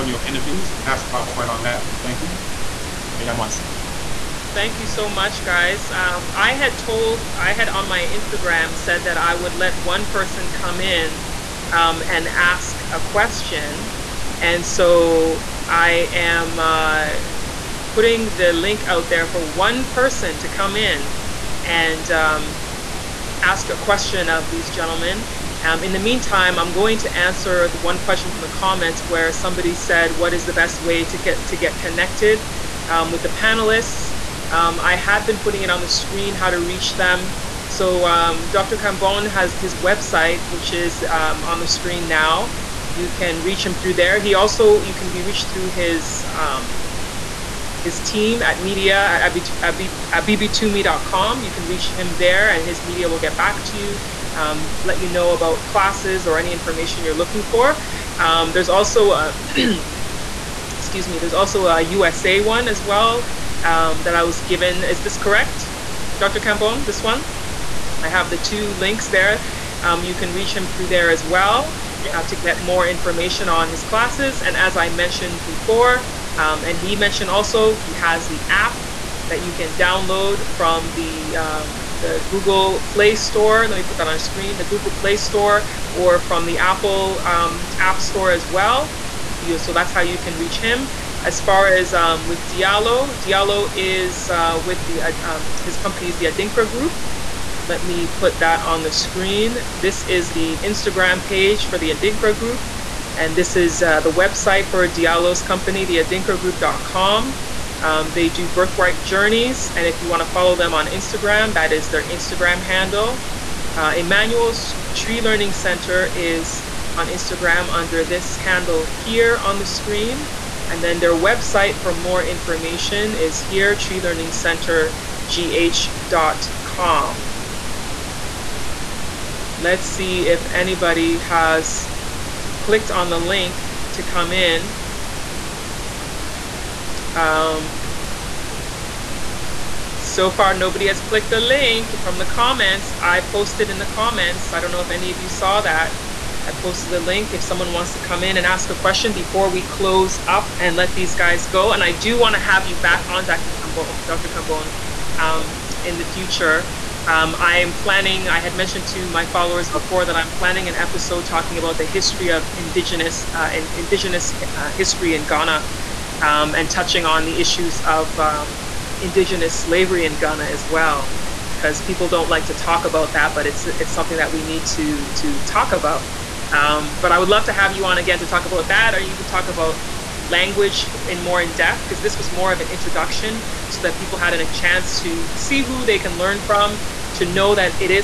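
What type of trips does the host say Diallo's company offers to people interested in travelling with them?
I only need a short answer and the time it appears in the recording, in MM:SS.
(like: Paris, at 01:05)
birthright journeys, at 01:48.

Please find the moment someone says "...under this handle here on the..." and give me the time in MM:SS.
01:57.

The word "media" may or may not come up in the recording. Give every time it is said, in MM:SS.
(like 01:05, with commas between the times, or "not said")
00:48, 00:52.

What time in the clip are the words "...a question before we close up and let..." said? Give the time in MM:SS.
02:28.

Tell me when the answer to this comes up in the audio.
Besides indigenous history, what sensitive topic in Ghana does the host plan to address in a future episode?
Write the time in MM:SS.
02:49.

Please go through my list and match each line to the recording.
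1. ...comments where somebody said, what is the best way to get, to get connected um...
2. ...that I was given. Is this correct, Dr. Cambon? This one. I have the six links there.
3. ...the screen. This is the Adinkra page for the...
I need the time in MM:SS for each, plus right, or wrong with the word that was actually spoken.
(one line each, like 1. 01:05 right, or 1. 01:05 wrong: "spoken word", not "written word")
1. 00:28 right
2. 01:04 wrong: "two", not "six"
3. 01:38 wrong: "Instagram", not "Adinkra".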